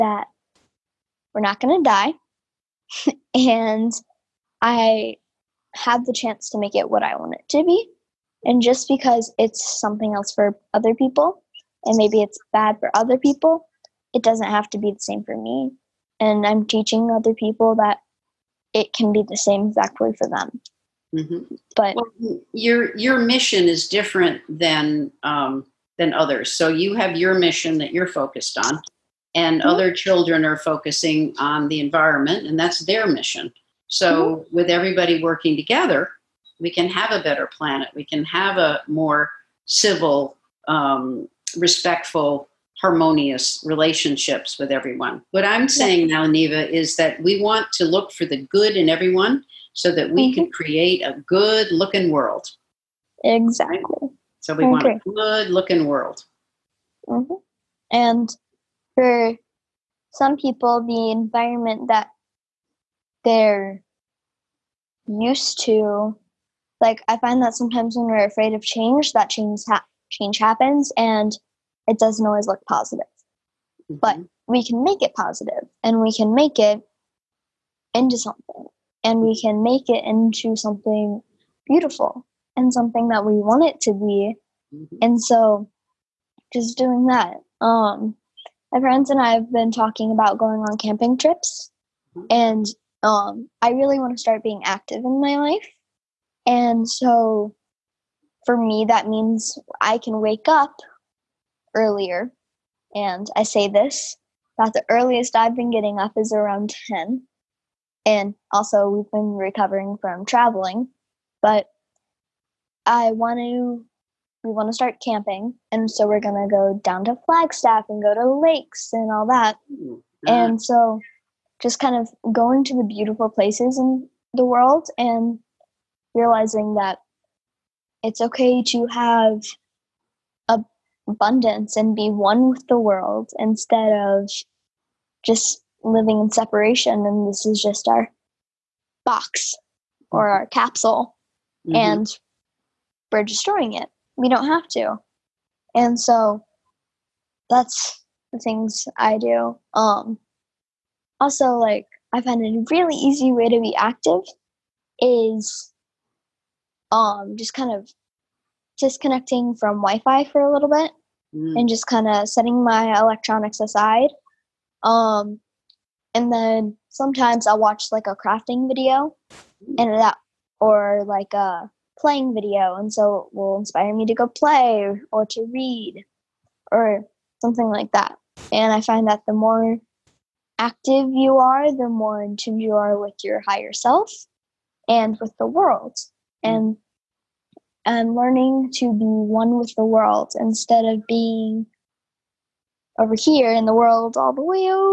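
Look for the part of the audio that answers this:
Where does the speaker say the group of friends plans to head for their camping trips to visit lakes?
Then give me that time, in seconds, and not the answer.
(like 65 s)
117 s.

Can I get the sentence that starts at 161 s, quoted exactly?
and just kind of setting my electronics aside.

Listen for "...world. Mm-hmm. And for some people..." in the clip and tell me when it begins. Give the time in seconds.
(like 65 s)
55 s.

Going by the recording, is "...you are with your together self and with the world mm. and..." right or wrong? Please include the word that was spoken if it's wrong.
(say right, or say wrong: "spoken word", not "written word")
wrong: "higher", not "together".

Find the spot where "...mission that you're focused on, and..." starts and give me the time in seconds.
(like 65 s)
27 s.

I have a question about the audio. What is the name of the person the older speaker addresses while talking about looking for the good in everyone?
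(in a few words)
Neva.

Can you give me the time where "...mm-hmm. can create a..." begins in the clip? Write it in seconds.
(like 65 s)
50 s.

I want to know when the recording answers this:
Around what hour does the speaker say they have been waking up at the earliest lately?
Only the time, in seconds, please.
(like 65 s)
106 s.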